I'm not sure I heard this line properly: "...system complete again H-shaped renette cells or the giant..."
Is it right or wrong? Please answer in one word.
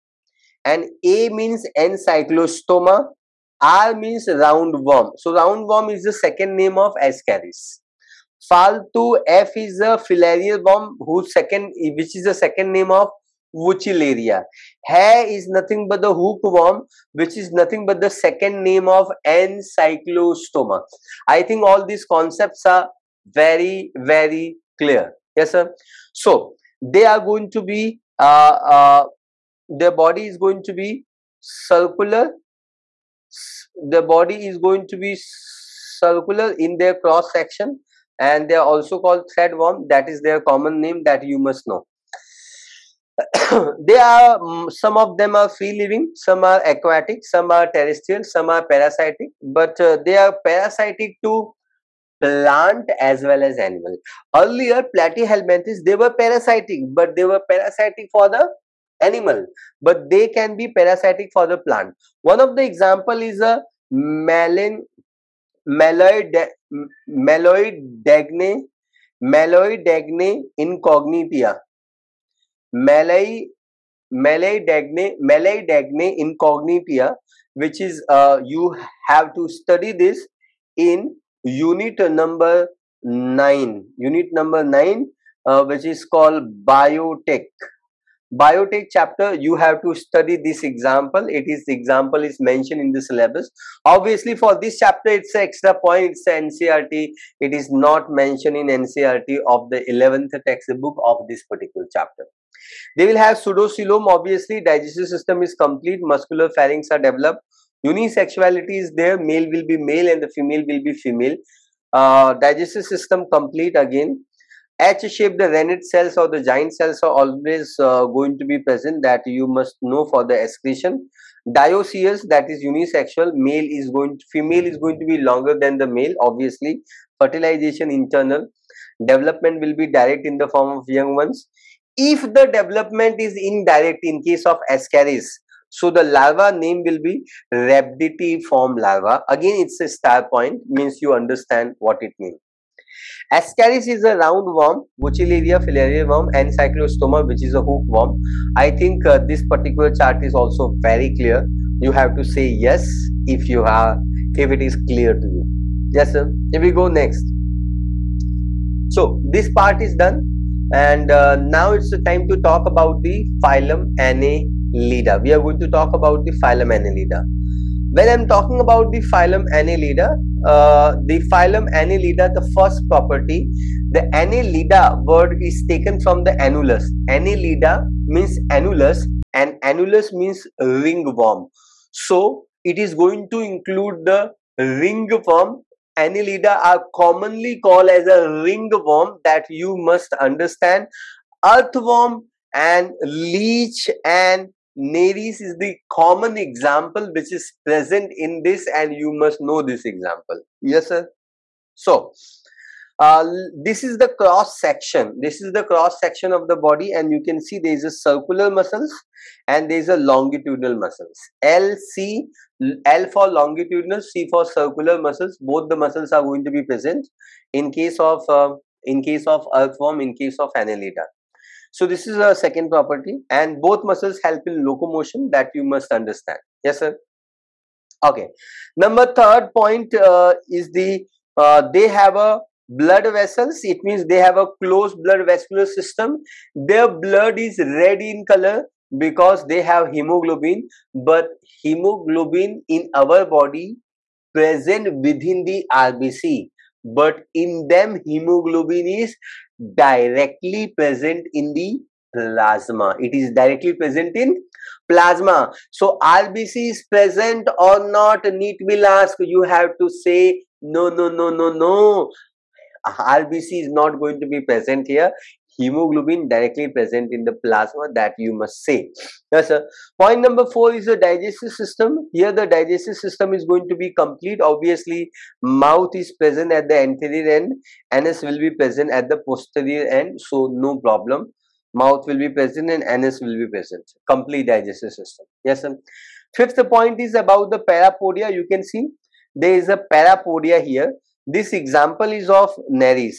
right.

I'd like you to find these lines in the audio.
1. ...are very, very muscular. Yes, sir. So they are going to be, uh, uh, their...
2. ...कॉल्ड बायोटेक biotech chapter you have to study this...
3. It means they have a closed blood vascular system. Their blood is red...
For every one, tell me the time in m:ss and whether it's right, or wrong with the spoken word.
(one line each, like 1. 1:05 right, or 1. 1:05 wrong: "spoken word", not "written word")
1. 0:22 wrong: "clear", not "muscular"
2. 1:26 right
3. 3:53 right.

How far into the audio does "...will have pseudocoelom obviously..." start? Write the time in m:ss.
1:43.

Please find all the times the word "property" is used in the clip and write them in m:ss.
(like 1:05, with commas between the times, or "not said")
2:52, 3:42.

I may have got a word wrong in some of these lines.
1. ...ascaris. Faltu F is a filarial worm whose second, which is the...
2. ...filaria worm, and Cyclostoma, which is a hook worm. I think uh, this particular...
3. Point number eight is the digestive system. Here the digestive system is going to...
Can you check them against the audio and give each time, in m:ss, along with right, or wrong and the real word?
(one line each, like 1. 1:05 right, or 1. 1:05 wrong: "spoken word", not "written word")
1. 0:07 right
2. 2:25 right
3. 4:29 wrong: "four", not "eight".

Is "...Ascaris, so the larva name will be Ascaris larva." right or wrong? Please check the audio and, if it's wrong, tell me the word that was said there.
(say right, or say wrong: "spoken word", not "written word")
wrong: "Rhabditiform", not "Ascaris".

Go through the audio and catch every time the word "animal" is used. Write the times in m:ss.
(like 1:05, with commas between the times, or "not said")
0:53, 0:58.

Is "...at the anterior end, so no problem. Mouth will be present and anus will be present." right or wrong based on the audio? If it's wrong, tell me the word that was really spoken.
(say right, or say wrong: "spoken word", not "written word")
wrong: "posterior", not "anterior".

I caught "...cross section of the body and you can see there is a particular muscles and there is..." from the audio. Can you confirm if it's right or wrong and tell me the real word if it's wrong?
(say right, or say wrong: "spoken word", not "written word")
wrong: "circular", not "particular".